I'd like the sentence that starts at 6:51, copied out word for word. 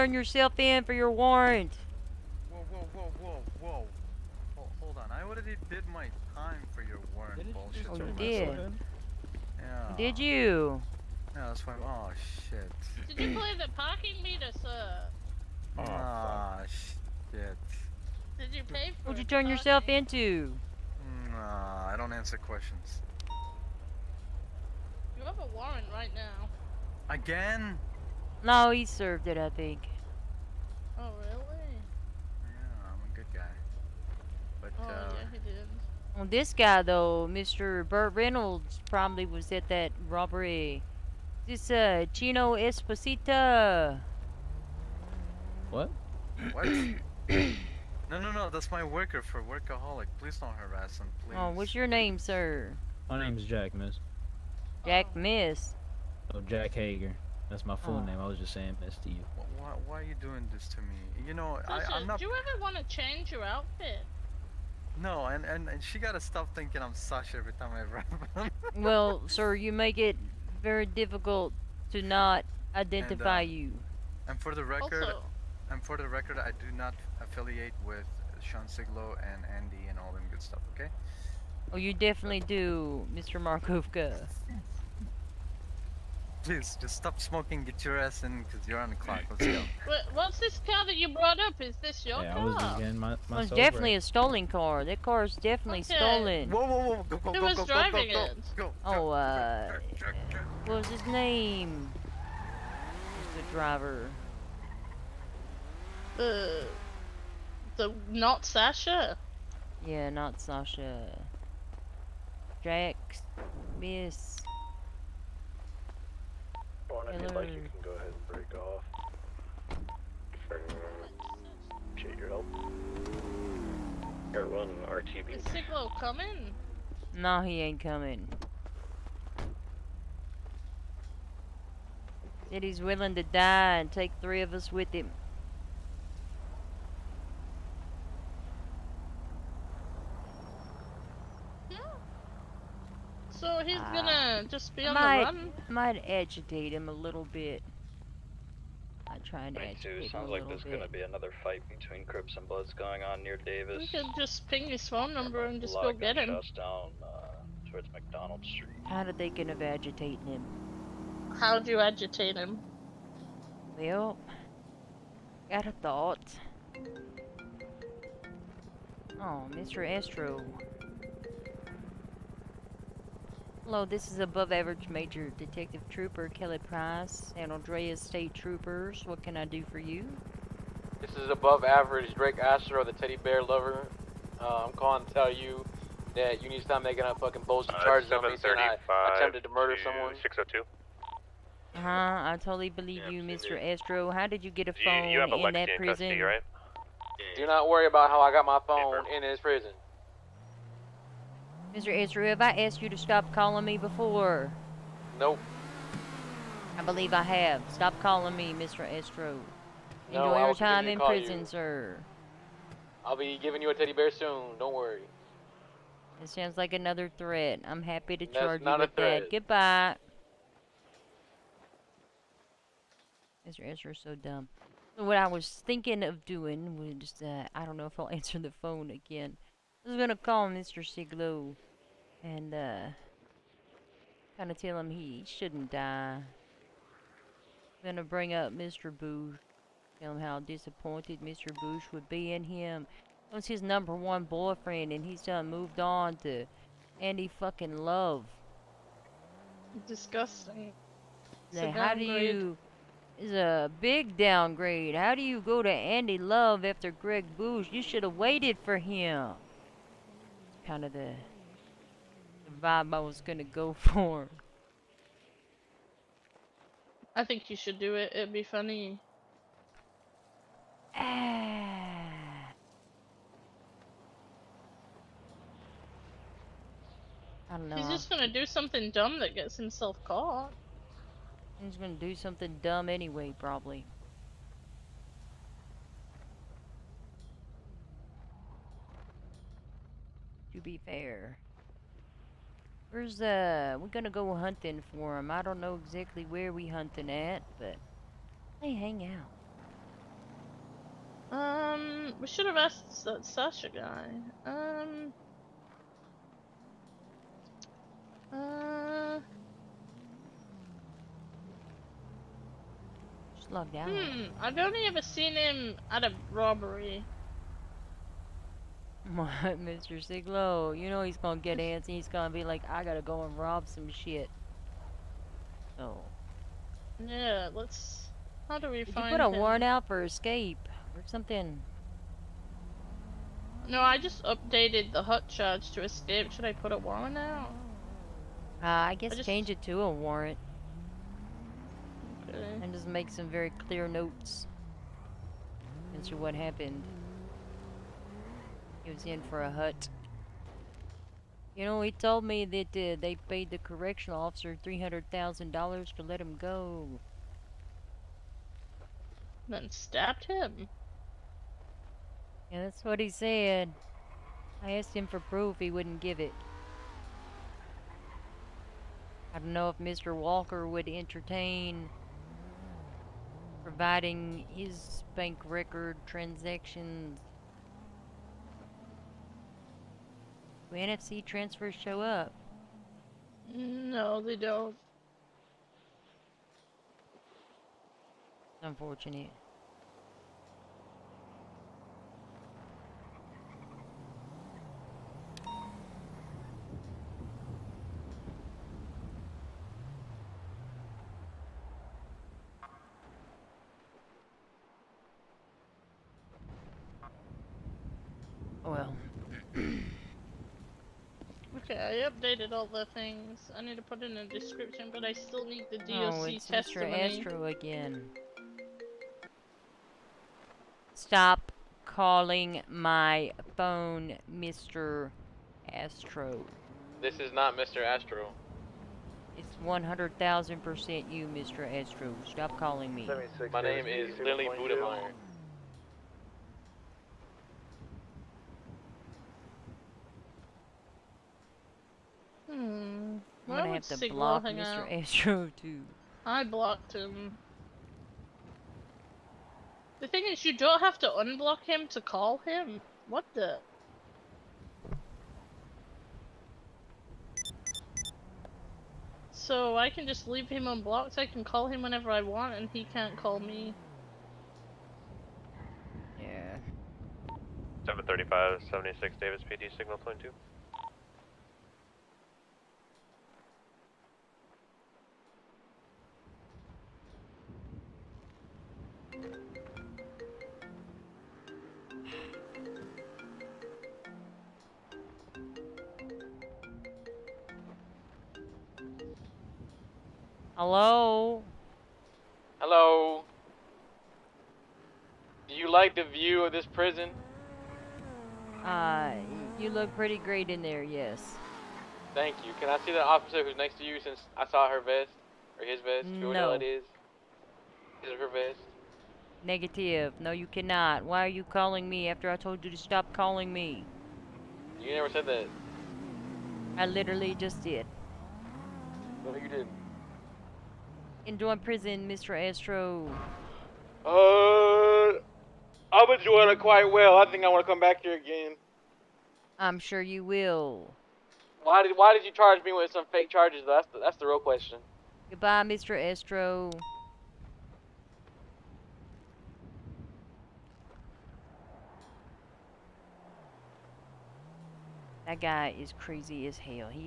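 Okay, I updated all the things.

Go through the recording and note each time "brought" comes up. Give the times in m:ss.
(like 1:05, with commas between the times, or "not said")
1:31.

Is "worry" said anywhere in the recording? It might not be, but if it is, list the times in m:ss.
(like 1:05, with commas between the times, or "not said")
3:17, 3:34.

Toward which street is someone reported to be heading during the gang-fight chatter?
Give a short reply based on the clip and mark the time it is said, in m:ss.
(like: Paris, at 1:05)
McDonald Street, at 2:37.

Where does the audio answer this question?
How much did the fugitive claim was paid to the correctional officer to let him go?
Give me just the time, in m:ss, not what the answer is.
5:54.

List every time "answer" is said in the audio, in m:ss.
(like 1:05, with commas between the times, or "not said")
0:22, 3:48.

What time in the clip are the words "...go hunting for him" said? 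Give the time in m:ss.
4:54.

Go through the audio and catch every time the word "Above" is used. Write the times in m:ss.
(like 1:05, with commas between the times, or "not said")
2:54, 3:01.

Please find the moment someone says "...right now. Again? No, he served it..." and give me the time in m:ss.
0:25.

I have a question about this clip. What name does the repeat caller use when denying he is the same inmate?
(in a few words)
Lily Budemeyer.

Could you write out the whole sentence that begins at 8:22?
Can I see the officer who's next to you since I saw her vest?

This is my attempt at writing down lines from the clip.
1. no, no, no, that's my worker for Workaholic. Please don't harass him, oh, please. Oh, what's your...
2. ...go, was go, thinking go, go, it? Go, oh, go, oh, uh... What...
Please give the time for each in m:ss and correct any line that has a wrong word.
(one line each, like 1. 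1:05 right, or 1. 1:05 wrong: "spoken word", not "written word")
1. 0:46 right
2. 1:37 wrong: "driving", not "thinking".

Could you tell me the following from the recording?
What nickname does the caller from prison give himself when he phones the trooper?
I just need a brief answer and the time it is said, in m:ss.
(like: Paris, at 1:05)
the teddy bear lover, at 3:02.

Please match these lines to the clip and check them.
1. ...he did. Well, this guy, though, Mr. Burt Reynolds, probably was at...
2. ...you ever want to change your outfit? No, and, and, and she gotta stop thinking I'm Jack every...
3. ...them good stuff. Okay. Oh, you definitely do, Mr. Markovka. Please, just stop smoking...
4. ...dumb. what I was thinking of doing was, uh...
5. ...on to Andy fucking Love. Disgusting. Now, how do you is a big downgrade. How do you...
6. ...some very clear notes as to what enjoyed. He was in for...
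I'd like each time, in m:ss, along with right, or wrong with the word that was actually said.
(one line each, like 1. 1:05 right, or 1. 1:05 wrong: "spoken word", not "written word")
1. 0:35 right
2. 1:02 wrong: "Sasha", not "Jack"
3. 1:20 right
4. 3:44 right
5. 4:05 right
6. 5:43 wrong: "happened", not "enjoyed".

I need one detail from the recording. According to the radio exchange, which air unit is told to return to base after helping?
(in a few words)
Air 1.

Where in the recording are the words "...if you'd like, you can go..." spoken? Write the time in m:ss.
1:57.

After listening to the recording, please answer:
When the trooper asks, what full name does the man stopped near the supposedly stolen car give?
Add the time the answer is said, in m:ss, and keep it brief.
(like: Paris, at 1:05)
Jack Hager, at 0:56.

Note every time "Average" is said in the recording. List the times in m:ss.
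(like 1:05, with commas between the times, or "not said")
2:54, 3:01.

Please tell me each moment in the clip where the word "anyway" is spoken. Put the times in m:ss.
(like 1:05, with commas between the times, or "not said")
4:42.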